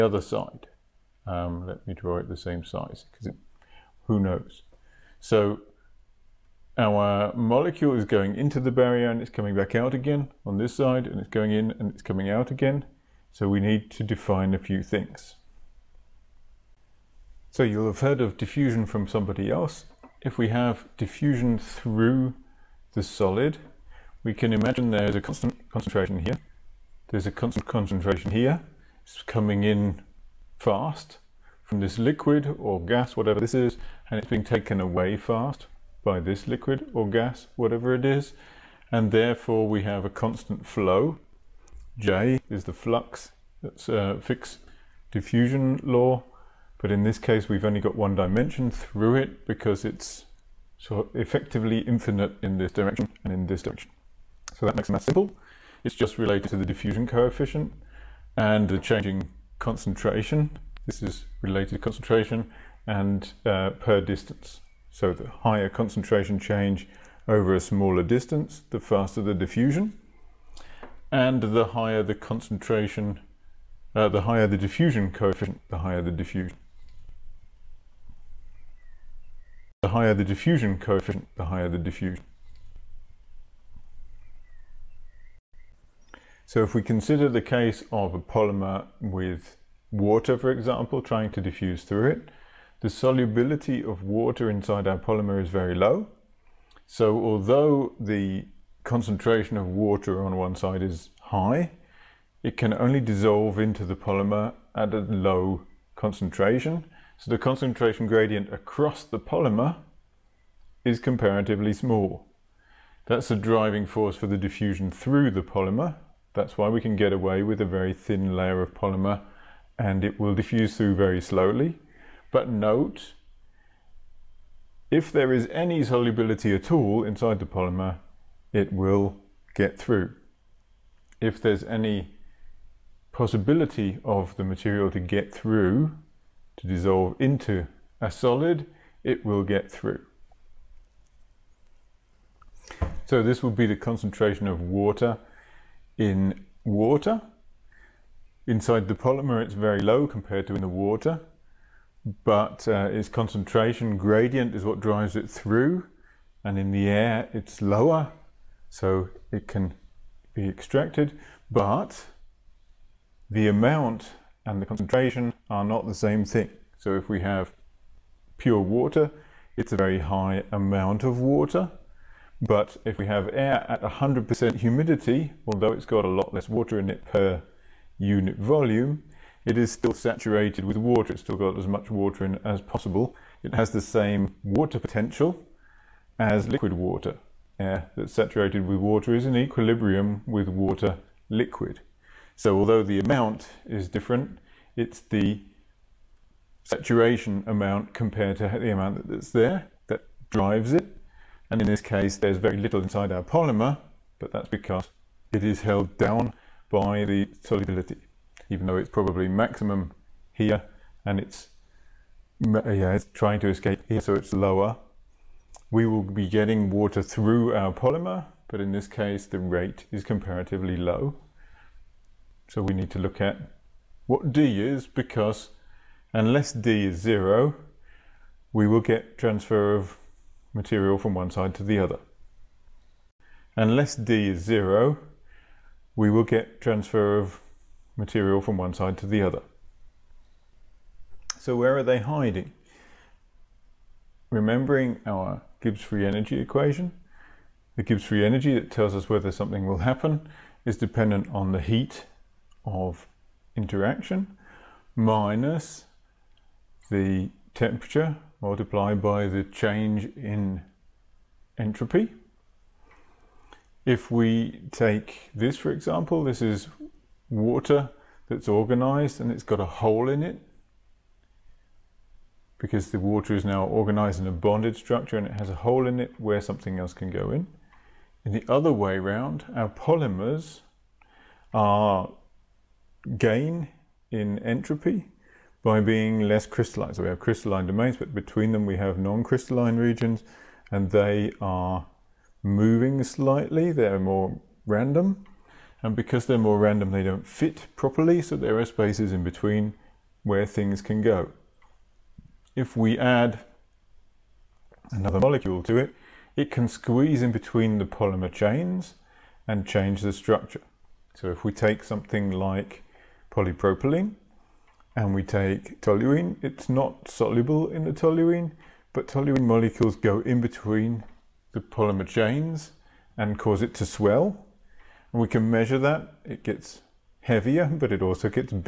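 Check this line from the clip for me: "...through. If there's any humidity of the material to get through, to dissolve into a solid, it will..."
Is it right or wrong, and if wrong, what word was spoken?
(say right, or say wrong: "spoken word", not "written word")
wrong: "possibility", not "humidity".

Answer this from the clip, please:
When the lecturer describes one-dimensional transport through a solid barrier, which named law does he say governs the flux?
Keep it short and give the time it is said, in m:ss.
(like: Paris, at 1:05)
Fick's diffusion law, at 0:44.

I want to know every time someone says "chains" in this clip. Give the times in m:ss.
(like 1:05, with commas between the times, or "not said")
5:08, 5:22.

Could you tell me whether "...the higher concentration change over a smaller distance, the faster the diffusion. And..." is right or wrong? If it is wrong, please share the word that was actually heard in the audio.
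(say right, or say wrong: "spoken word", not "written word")
right.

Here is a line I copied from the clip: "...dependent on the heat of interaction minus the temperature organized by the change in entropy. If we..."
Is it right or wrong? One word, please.
wrong.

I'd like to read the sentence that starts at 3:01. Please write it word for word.
It's still got as much water in as possible.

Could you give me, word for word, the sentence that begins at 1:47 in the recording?
So the concentration gradient across the polymer is comparatively small.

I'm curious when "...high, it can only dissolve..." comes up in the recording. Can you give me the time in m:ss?
1:41.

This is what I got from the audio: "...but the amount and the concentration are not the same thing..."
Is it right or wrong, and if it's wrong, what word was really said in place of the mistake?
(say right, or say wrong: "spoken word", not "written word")
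right.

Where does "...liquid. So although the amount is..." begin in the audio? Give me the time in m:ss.
3:11.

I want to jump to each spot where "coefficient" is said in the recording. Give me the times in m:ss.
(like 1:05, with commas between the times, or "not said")
0:57, 1:15, 1:20.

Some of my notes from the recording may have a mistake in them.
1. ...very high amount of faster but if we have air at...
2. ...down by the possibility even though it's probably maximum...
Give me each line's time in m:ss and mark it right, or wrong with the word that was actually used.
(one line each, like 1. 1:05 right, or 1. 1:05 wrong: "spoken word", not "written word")
1. 2:49 wrong: "water", not "faster"
2. 3:25 wrong: "solubility", not "possibility".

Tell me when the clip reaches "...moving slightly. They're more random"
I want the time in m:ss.
4:52.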